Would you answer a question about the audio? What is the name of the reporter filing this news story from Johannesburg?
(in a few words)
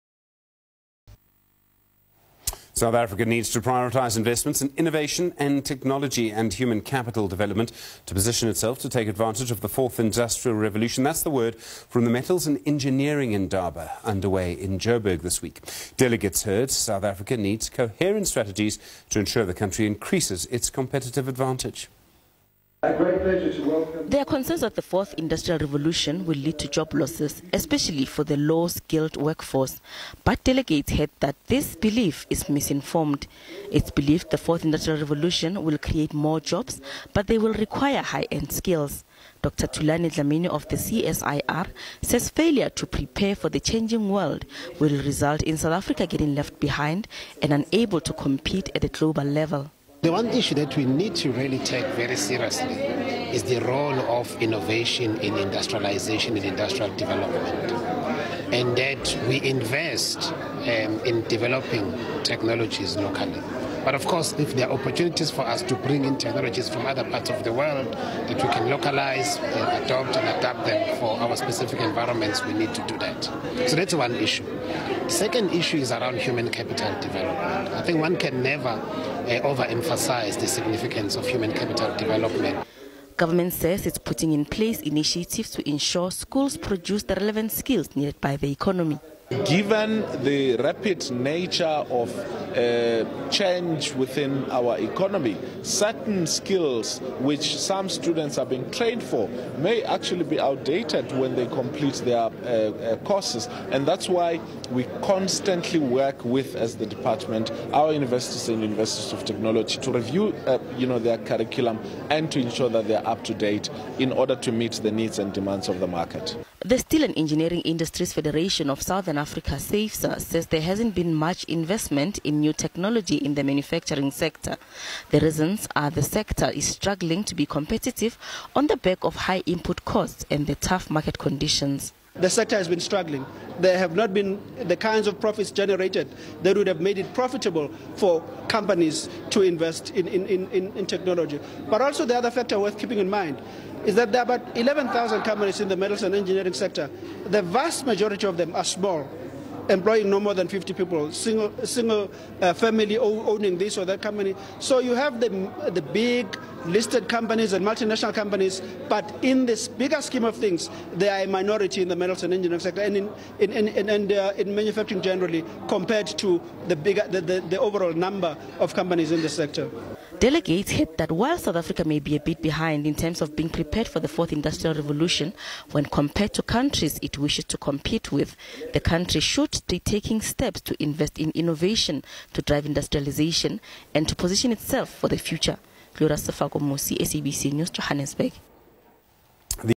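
Glora Safako.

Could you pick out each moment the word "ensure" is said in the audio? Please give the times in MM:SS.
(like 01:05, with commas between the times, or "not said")
00:19, 01:25, 01:52.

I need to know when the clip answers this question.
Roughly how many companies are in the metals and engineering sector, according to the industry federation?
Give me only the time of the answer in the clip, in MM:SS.
02:24.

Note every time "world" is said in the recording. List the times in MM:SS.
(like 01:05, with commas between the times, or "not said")
00:44, 01:07.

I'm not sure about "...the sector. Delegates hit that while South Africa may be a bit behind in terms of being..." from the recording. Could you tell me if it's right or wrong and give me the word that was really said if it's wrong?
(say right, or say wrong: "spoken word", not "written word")
right.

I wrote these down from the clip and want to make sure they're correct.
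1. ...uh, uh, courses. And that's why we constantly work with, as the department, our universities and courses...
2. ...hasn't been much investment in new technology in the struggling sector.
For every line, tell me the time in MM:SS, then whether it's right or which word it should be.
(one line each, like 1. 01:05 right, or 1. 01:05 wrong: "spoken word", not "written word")
1. 01:42 wrong: "universities", not "courses"
2. 02:00 wrong: "manufacturing", not "struggling".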